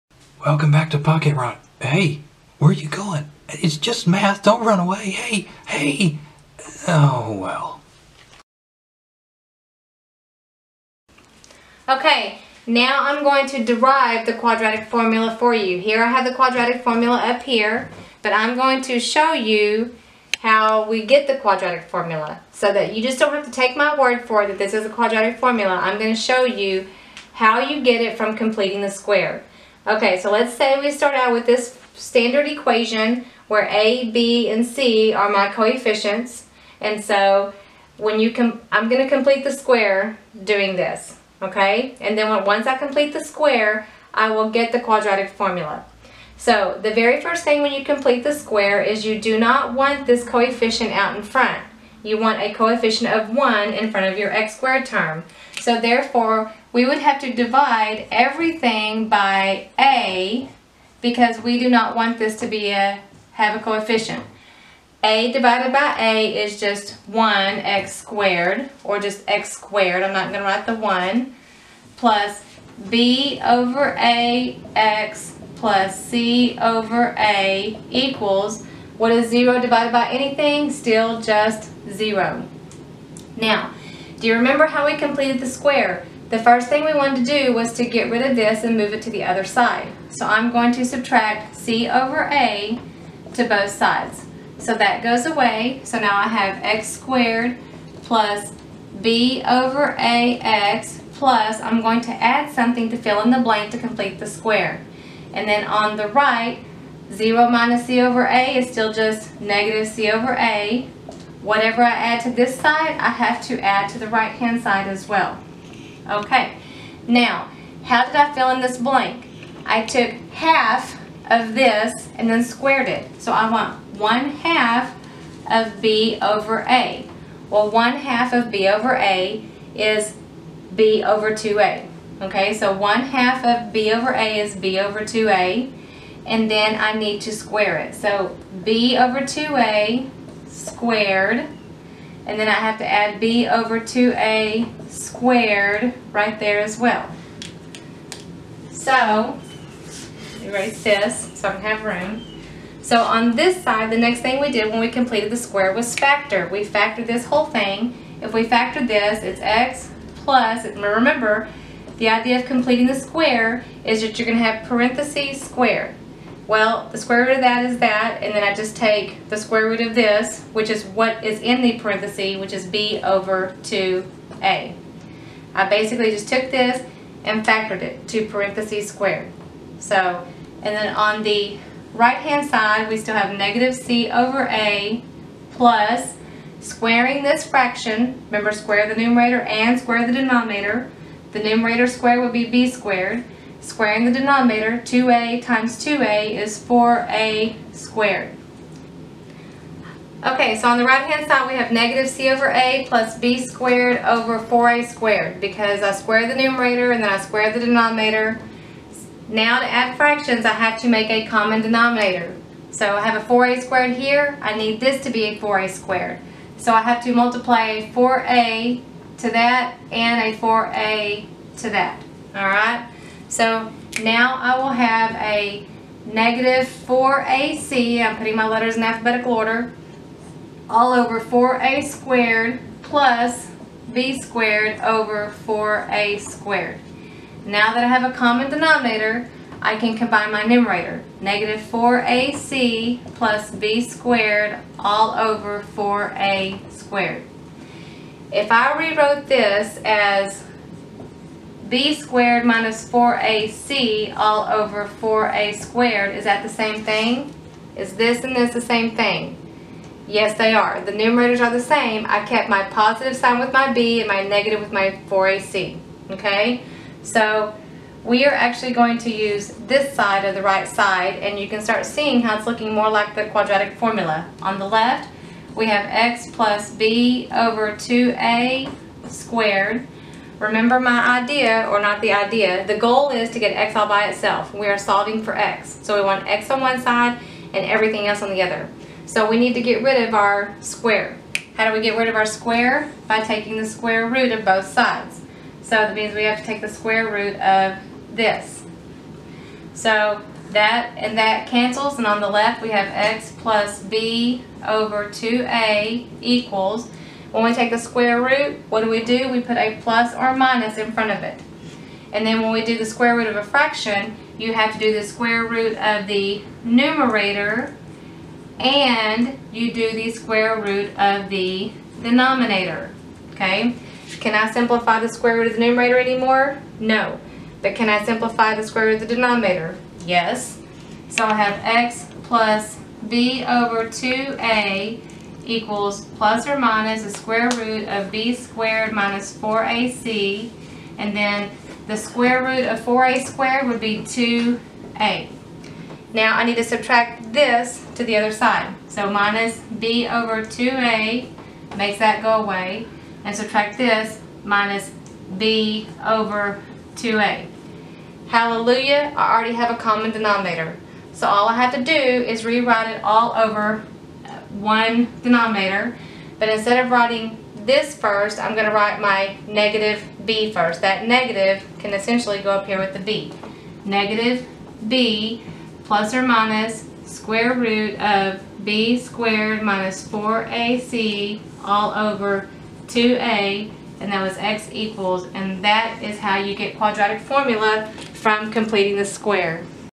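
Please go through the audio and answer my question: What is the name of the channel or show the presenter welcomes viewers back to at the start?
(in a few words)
Pocket Roni.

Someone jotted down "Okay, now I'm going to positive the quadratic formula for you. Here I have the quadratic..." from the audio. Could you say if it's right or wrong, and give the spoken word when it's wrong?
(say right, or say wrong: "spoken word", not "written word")
wrong: "derive", not "positive".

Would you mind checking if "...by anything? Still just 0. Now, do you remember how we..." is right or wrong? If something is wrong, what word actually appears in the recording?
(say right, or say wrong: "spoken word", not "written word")
right.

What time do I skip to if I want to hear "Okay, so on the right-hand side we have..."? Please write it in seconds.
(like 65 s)
200 s.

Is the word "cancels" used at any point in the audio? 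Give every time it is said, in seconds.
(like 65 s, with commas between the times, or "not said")
301 s.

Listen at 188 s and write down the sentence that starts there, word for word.
Remember, square the numerator and square the denominator.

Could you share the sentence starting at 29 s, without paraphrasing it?
Okay, so let's say we start out with this standard equation where A, B, and C are my coefficients.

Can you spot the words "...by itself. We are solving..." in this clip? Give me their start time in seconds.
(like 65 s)
283 s.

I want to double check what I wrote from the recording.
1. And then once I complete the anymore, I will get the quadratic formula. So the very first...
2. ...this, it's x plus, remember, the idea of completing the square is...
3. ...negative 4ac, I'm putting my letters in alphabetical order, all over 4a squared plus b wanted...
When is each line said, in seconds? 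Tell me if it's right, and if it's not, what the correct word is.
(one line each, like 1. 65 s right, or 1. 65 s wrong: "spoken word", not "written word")
1. 41 s wrong: "square", not "anymore"
2. 158 s right
3. 226 s wrong: "squared", not "wanted".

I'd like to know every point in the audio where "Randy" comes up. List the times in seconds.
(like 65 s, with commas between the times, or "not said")
not said.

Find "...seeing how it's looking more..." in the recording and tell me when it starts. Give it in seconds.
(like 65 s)
271 s.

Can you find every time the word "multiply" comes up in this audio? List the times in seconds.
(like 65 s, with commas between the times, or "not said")
217 s.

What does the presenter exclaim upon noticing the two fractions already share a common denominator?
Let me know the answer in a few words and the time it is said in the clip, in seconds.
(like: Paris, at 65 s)
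Hallelujah, at 358 s.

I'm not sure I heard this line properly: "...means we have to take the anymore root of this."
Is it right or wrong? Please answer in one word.
wrong.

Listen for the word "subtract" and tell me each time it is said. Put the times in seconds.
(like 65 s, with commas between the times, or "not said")
90 s, 346 s, 353 s.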